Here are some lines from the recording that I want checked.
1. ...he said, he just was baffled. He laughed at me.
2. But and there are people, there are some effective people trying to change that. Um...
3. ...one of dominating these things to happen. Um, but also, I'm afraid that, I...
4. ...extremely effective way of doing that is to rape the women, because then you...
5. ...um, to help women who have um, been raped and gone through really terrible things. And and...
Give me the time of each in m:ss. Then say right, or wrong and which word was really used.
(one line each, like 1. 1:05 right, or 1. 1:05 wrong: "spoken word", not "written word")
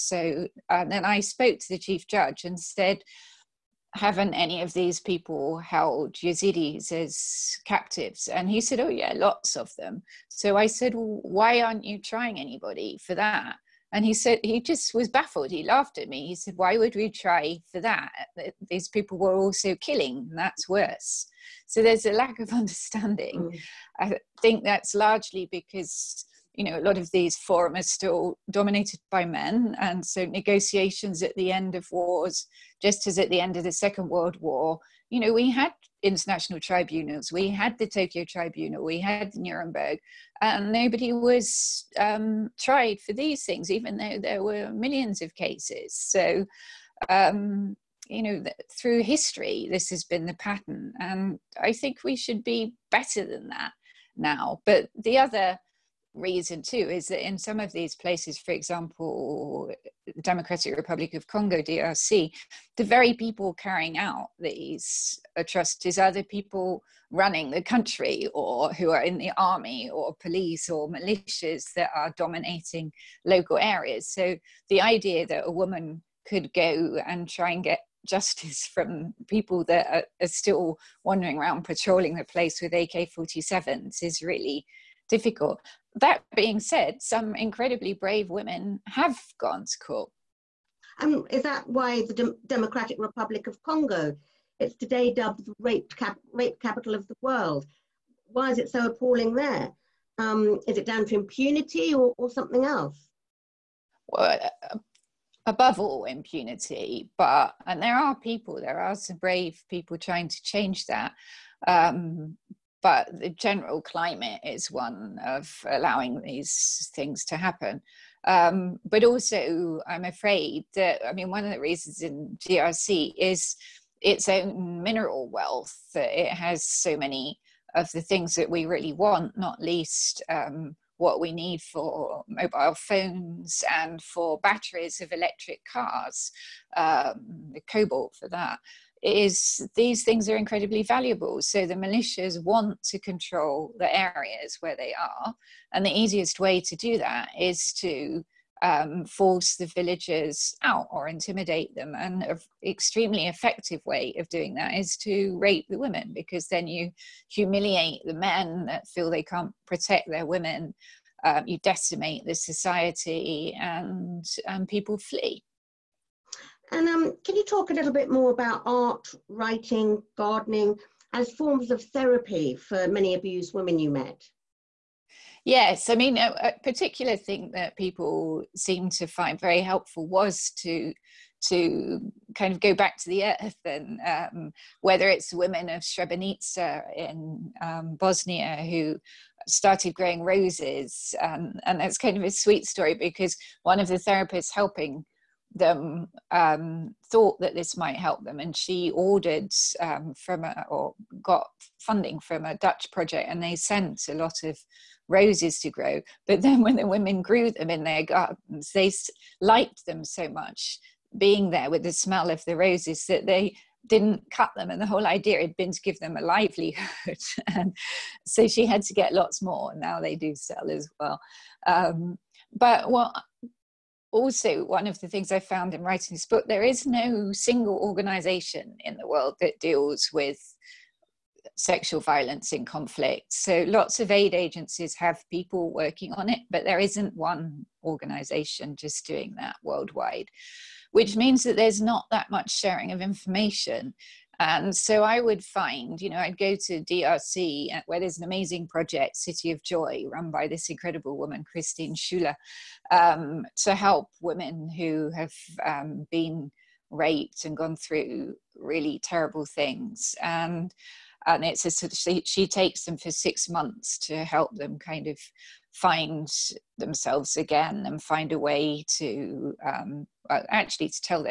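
1. 0:14 right
2. 1:47 wrong: "brave", not "effective"
3. 1:54 wrong: "allowing", not "dominating"
4. 2:32 right
5. 4:12 right.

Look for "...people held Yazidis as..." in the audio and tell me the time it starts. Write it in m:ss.
0:05.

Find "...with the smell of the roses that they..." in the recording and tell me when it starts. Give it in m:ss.
3:31.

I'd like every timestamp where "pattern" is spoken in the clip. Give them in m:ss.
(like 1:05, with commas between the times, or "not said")
0:50.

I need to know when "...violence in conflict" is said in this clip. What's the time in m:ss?
3:52.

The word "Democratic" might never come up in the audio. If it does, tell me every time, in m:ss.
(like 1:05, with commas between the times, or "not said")
1:00, 1:32.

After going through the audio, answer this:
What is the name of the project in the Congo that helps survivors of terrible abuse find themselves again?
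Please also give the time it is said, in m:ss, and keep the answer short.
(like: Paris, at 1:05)
City of Joy, at 4:09.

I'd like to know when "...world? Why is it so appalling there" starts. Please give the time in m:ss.
1:37.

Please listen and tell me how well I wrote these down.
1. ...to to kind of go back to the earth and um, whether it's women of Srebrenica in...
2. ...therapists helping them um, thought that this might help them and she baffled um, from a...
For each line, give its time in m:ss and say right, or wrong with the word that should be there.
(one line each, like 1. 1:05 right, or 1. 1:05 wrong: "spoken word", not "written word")
1. 3:00 right
2. 3:13 wrong: "ordered", not "baffled".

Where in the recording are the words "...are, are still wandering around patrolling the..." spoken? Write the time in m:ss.
1:19.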